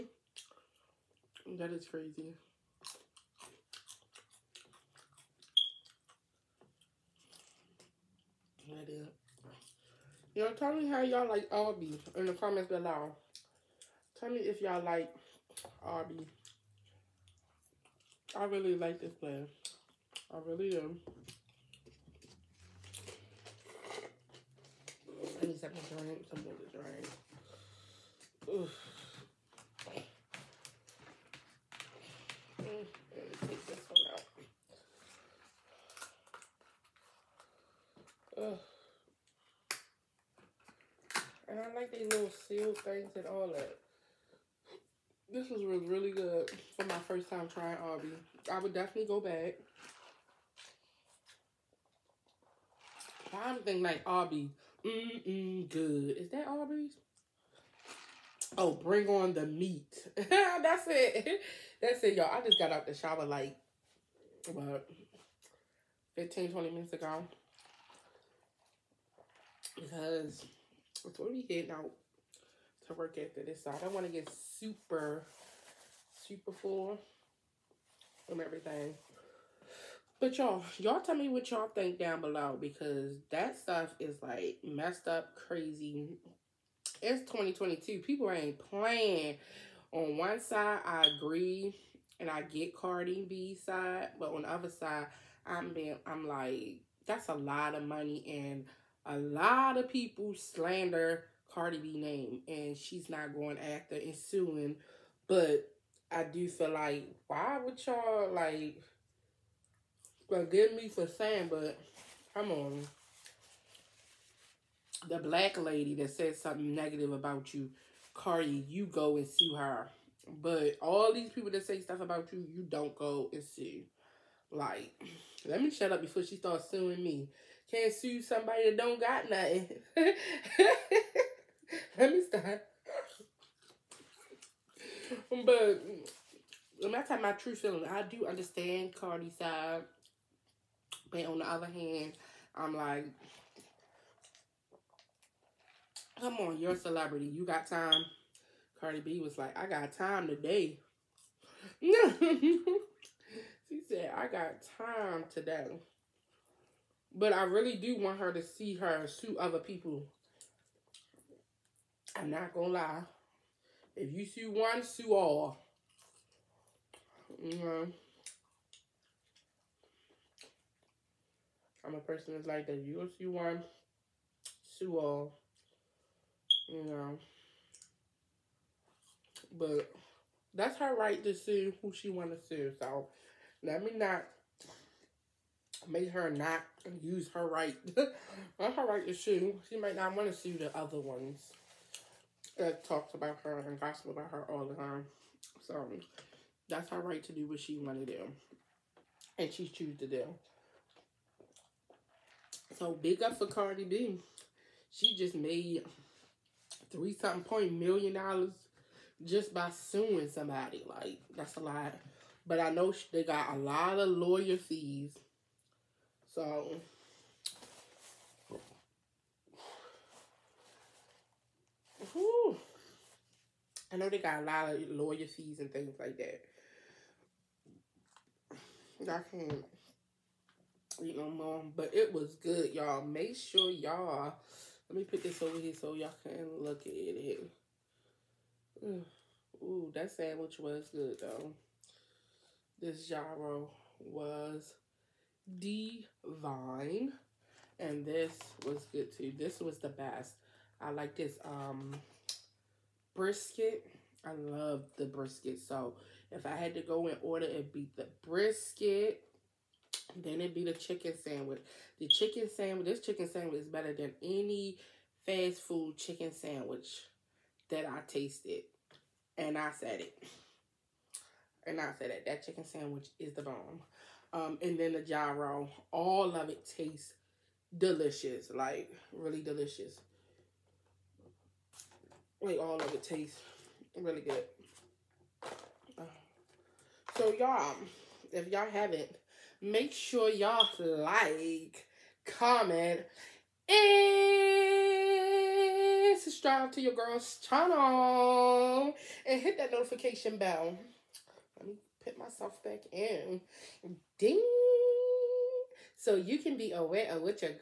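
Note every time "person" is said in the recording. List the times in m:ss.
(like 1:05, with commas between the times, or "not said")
2:51.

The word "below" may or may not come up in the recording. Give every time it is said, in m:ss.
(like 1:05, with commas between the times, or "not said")
0:12, 1:22.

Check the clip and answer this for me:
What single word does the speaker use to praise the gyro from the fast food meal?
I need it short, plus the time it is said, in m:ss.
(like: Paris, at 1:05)
divine, at 4:05.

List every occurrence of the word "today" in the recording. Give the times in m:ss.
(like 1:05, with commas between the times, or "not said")
2:30, 2:35.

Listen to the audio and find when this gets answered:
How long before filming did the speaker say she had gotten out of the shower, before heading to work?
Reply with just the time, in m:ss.
1:06.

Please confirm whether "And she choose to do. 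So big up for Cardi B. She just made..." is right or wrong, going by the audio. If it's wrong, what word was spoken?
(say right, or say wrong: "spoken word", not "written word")
right.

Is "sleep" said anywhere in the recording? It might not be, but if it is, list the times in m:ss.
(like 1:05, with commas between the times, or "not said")
not said.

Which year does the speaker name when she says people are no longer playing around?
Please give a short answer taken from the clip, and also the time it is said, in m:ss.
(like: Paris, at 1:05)
2022, at 1:27.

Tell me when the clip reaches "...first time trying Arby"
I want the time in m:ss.
0:47.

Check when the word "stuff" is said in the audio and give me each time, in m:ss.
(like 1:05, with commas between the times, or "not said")
1:23, 2:01.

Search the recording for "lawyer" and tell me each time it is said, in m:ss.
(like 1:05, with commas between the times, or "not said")
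3:34, 3:44.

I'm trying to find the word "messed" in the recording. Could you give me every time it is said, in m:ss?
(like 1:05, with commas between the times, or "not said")
1:24.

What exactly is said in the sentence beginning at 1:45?
But I do feel like why would y'all like forgive me for saying, but come on.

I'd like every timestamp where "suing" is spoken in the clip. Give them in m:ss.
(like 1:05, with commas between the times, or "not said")
1:44, 2:06, 3:29.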